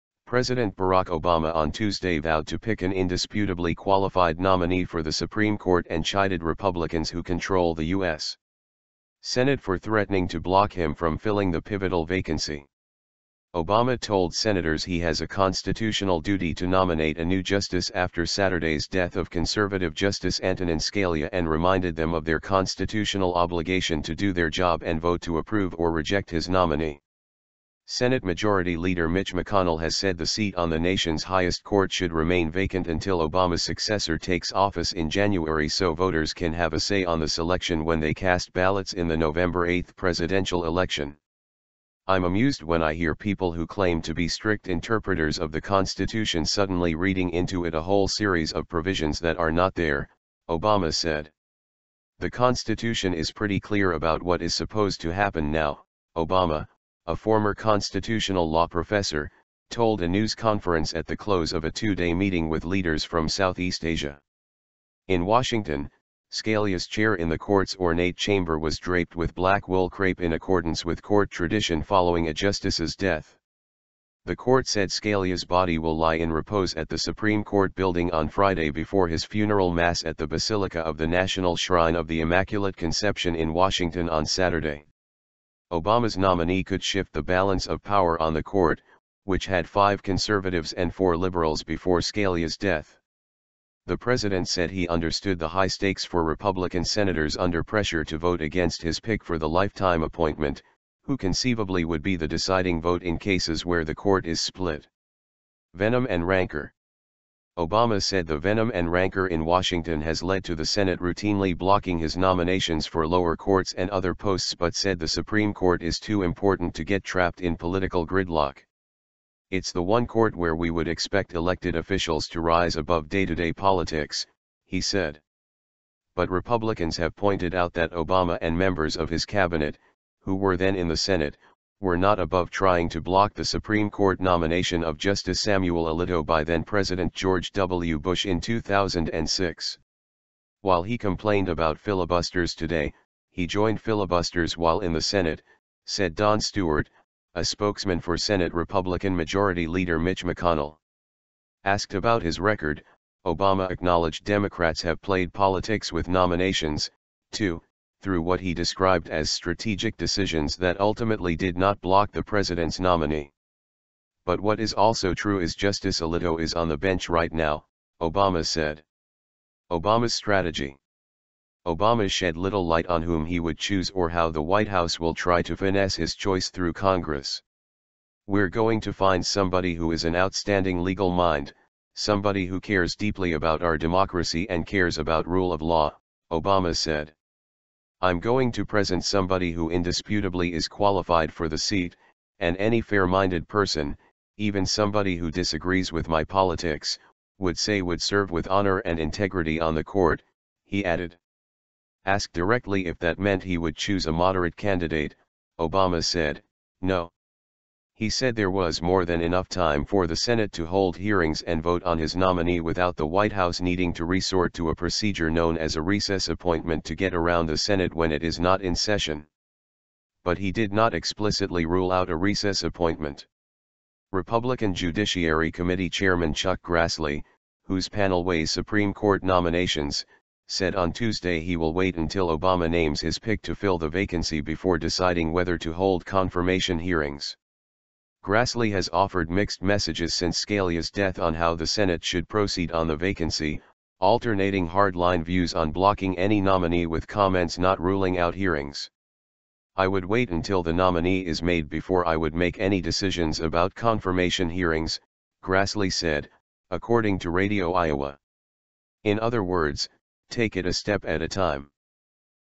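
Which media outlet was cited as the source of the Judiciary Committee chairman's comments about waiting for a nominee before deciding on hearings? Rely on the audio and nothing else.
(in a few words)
Radio Iowa.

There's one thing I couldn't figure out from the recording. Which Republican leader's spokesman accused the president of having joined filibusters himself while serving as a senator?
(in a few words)
Don Stewart.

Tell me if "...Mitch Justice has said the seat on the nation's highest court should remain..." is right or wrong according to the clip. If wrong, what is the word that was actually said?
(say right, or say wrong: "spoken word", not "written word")
wrong: "McConnell", not "Justice".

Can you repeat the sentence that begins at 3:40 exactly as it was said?
But he did not explicitly rule out a recess appointment.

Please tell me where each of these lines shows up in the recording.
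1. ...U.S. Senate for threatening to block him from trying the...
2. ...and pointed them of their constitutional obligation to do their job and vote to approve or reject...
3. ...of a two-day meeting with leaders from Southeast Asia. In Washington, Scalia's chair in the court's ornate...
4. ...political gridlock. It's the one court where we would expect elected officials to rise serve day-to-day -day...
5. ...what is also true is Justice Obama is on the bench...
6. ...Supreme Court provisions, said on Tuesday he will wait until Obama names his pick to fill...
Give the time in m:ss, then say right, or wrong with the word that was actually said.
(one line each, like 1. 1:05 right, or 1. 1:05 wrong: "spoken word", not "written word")
1. 0:07 wrong: "filling", not "trying"
2. 0:21 wrong: "reminded", not "pointed"
3. 1:01 right
4. 1:57 wrong: "above", not "serve"
5. 2:44 wrong: "Alito", not "Obama"
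6. 3:48 wrong: "nominations", not "provisions".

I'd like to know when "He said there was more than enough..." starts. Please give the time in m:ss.
3:28.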